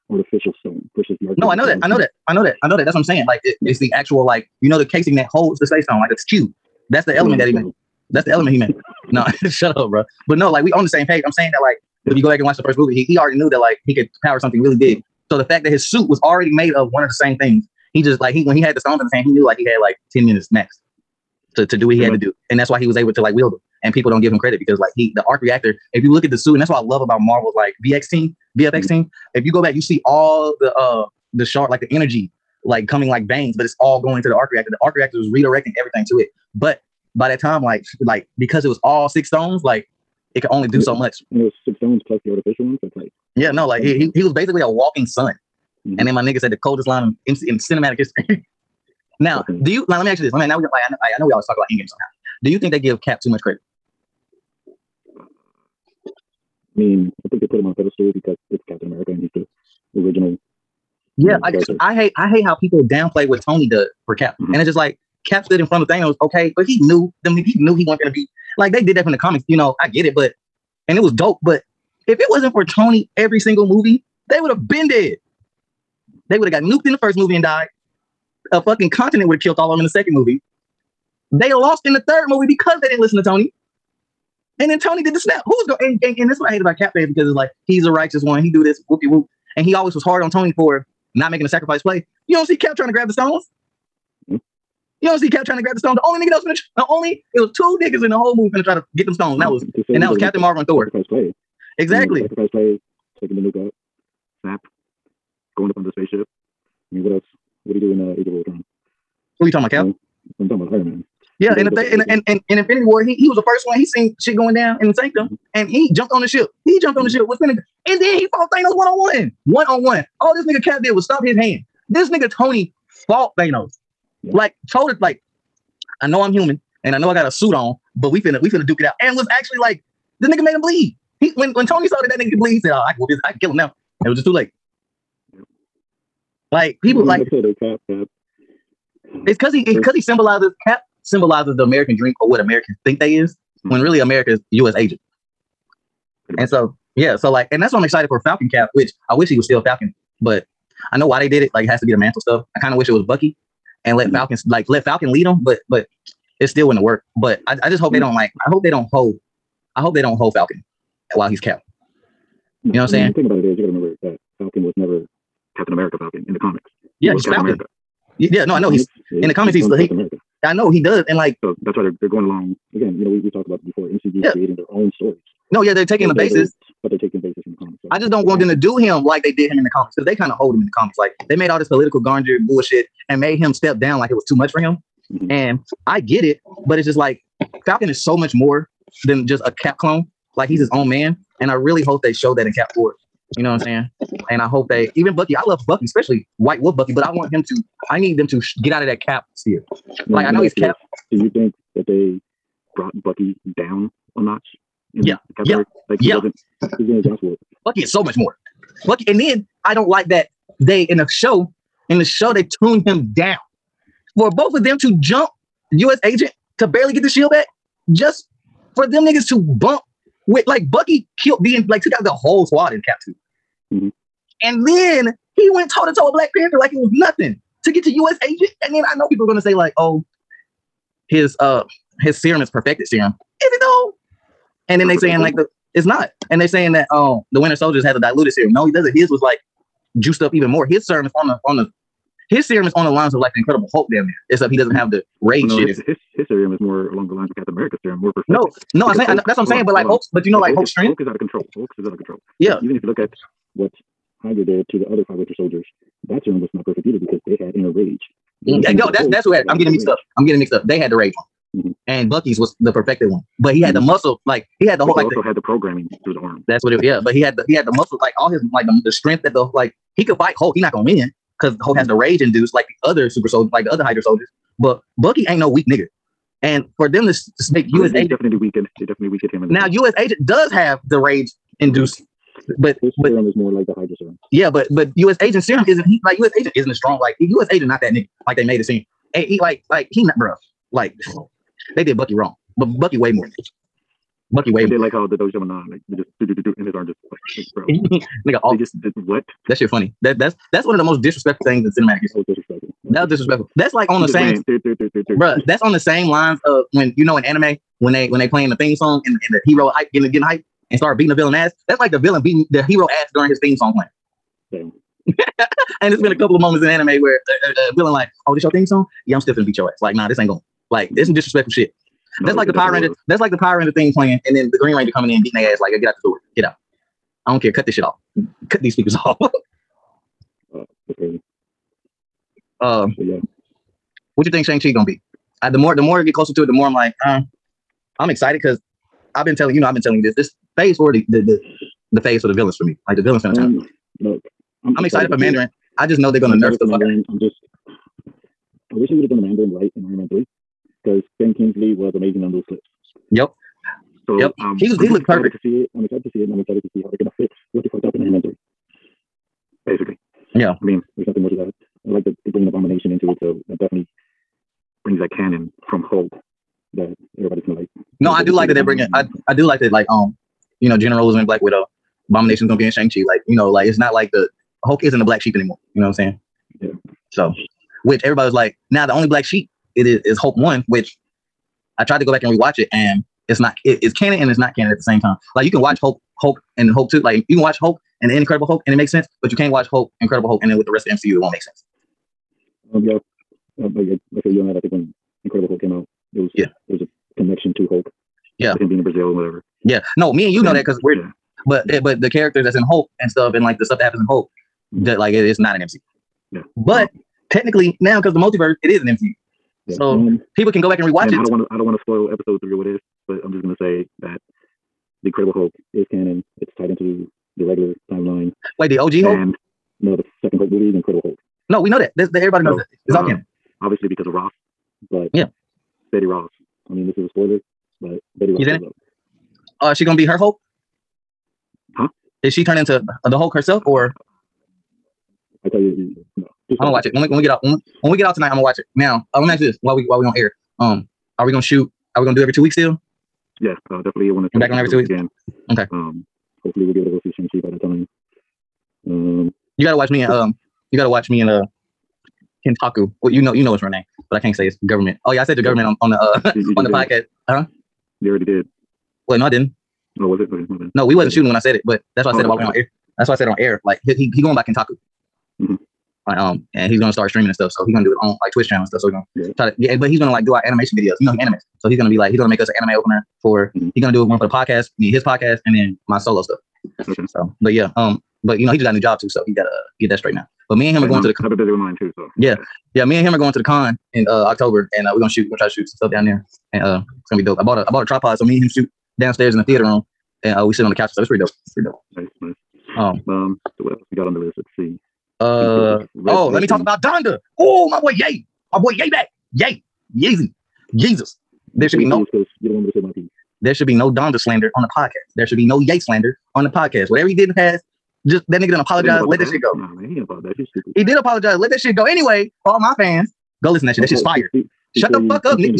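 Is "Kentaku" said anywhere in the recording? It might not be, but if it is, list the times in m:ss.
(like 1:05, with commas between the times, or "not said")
7:32, 7:44.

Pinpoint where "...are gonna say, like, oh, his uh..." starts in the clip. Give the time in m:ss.
3:49.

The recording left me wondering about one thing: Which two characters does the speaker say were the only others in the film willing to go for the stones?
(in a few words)
Captain Marvel and Thor.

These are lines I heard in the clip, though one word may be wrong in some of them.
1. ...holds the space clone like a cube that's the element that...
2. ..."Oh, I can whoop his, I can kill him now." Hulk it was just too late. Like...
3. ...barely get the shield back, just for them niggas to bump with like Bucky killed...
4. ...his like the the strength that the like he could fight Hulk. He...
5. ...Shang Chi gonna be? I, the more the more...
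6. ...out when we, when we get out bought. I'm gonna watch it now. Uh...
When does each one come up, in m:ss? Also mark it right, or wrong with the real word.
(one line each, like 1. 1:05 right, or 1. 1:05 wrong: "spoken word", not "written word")
1. 0:05 wrong: "stone", not "clone"
2. 2:12 wrong: "And", not "Hulk"
3. 3:36 right
4. 4:28 right
5. 5:34 right
6. 7:17 wrong: "tonight", not "bought".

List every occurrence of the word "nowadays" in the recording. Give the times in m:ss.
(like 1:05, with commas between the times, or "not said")
not said.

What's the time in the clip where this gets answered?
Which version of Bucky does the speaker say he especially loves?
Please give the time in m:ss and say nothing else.
3:16.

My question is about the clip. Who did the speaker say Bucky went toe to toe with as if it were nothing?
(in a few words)
Black Panther.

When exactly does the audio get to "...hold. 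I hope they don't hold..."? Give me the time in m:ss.
2:38.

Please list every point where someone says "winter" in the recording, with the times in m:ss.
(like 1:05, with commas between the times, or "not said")
3:57, 4:15.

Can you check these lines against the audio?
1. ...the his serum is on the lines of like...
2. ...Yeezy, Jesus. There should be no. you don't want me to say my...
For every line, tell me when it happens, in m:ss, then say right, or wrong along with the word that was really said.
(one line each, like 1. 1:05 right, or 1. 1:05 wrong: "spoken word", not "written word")
1. 4:01 right
2. 8:19 right.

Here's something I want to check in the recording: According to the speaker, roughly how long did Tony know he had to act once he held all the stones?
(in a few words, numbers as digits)
10 minutes.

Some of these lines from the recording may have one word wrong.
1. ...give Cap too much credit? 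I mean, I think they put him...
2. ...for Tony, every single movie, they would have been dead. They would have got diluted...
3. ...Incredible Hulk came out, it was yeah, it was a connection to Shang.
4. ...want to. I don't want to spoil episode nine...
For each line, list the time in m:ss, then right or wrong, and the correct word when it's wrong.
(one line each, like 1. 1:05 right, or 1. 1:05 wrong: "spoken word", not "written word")
1. 0:52 right
2. 1:12 wrong: "nuked", not "diluted"
3. 6:35 wrong: "Hulk", not "Shang"
4. 6:51 wrong: "three", not "nine".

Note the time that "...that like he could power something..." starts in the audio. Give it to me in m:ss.
0:13.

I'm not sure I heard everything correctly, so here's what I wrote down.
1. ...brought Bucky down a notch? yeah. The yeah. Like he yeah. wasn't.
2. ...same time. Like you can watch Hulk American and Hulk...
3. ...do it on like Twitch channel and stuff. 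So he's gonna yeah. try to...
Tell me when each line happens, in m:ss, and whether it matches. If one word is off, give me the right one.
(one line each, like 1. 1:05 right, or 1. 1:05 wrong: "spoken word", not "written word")
1. 3:22 right
2. 6:24 wrong: "Hulk", not "American"
3. 7:47 right.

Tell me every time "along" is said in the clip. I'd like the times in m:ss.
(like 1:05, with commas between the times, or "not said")
2:52, 4:06.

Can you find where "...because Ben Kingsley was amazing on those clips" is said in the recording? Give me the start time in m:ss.
5:50.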